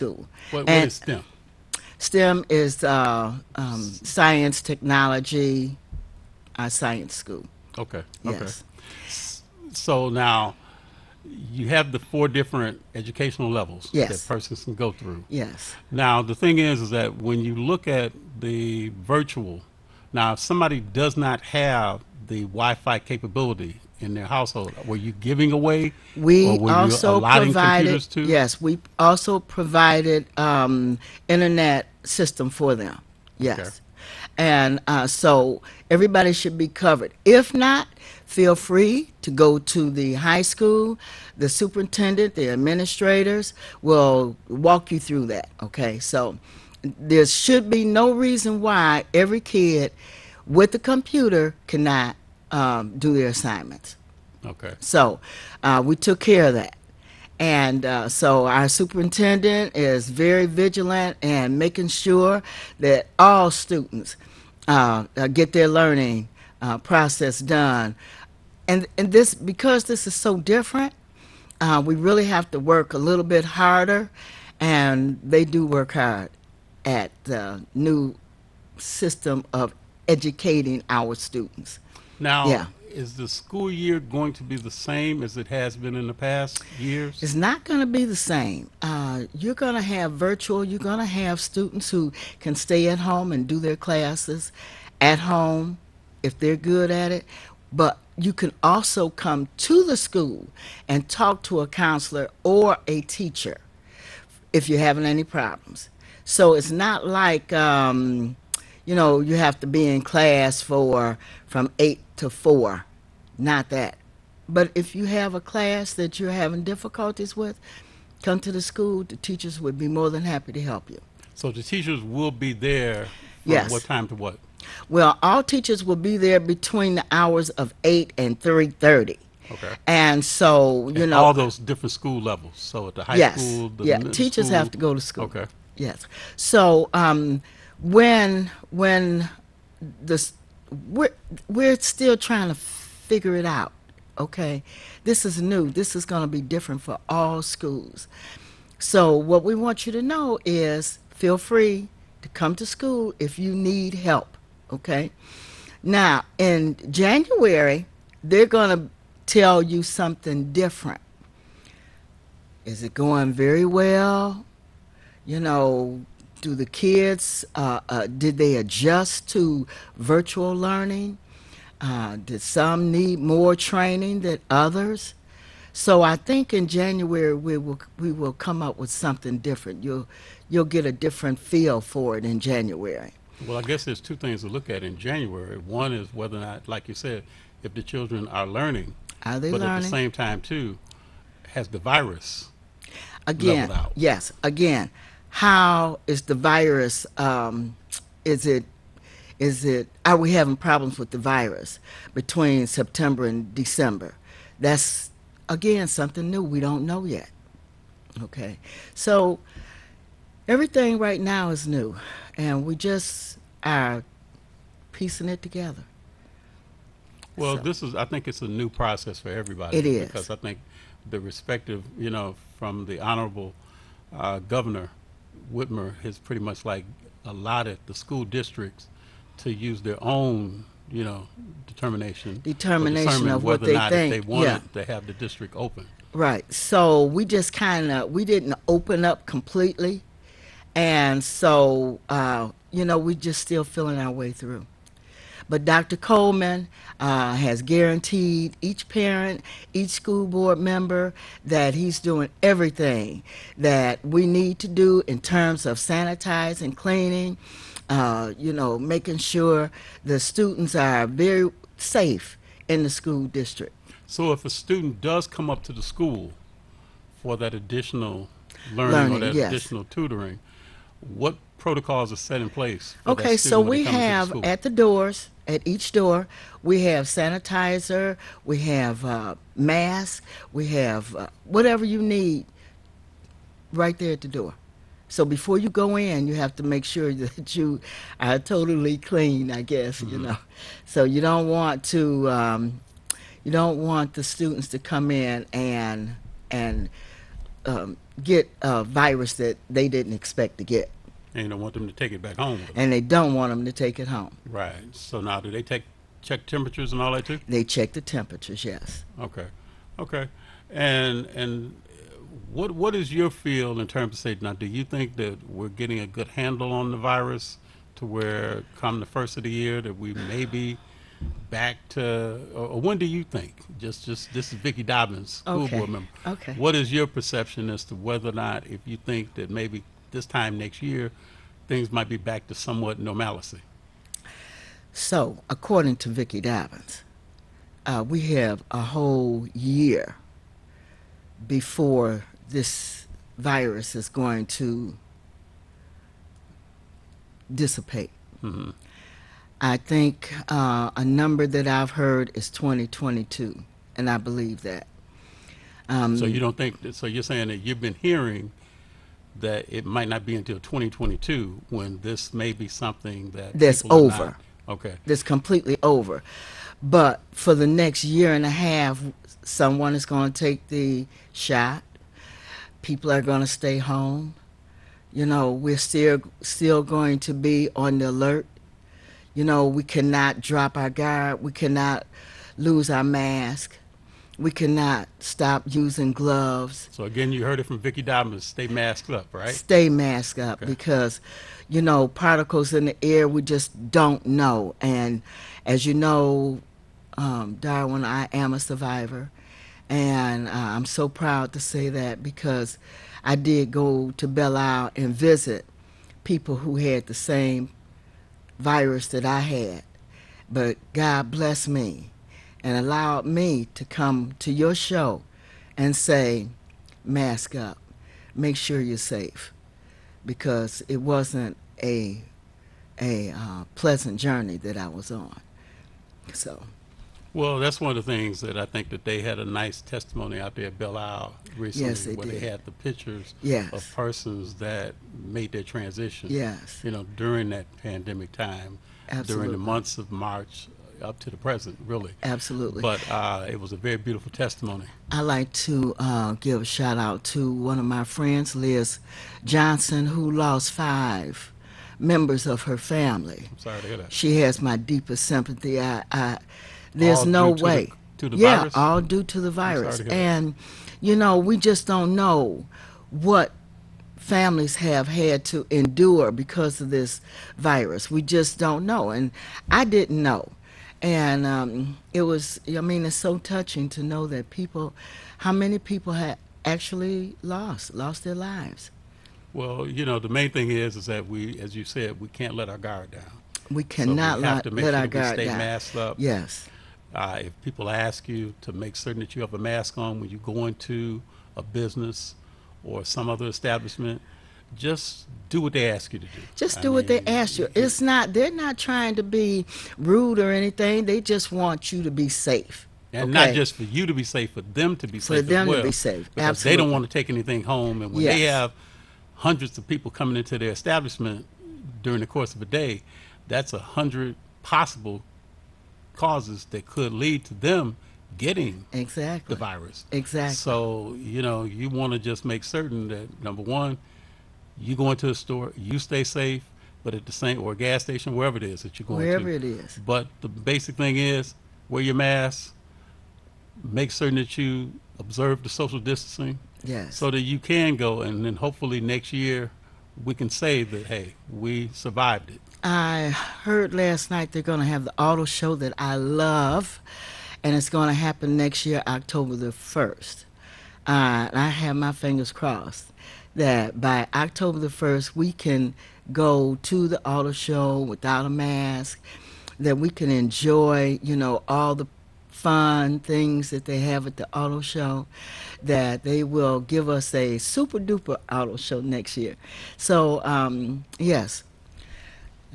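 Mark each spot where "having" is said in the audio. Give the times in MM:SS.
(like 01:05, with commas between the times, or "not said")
01:44, 01:56, 03:20.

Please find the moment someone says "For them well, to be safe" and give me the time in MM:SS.
08:25.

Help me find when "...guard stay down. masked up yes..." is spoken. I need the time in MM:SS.
08:05.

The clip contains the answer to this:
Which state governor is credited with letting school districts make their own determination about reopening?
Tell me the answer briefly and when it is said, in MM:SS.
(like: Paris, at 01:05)
Governor Whitmer, at 03:44.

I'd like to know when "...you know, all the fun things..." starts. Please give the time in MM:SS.
09:21.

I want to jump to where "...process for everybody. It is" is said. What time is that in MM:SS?
03:38.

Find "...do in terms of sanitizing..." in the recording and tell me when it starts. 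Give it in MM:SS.
04:14.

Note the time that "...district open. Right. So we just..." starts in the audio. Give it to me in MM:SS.
03:55.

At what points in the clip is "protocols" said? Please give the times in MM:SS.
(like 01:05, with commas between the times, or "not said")
04:31.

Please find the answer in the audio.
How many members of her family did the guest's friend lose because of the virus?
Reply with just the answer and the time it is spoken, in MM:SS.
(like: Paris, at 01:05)
5, at 07:30.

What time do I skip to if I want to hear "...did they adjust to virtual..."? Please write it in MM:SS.
02:48.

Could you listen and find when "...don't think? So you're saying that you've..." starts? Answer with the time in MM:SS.
05:56.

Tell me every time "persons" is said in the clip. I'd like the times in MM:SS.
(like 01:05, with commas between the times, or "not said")
00:14, 07:13.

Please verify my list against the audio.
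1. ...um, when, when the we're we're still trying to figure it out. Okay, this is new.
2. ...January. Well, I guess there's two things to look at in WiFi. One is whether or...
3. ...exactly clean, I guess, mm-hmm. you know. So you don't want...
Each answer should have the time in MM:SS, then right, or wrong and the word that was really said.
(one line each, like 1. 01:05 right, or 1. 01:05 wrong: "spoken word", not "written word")
1. 02:16 right
2. 03:02 wrong: "January", not "WiFi"
3. 04:48 wrong: "totally", not "exactly".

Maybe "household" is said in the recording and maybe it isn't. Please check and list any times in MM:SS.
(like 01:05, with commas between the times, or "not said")
00:24.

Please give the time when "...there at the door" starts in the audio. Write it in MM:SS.
04:43.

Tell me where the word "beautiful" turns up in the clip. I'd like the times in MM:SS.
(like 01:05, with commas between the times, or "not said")
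07:23.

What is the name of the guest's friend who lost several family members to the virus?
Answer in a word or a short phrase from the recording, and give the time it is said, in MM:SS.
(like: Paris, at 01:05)
Liz Johnson, at 07:28.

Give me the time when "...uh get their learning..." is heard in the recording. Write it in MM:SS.
01:05.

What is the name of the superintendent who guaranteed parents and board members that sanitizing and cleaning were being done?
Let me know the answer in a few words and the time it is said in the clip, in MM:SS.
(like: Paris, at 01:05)
Dr. Coleman, at 04:05.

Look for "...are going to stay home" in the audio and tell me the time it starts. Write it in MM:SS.
06:13.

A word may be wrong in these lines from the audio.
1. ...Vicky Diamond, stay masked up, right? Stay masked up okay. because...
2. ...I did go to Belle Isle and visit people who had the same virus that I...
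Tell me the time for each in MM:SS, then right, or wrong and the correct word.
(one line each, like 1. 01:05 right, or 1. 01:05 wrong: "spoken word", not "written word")
1. 06:27 right
2. 06:43 right.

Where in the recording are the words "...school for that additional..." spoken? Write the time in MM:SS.
04:25.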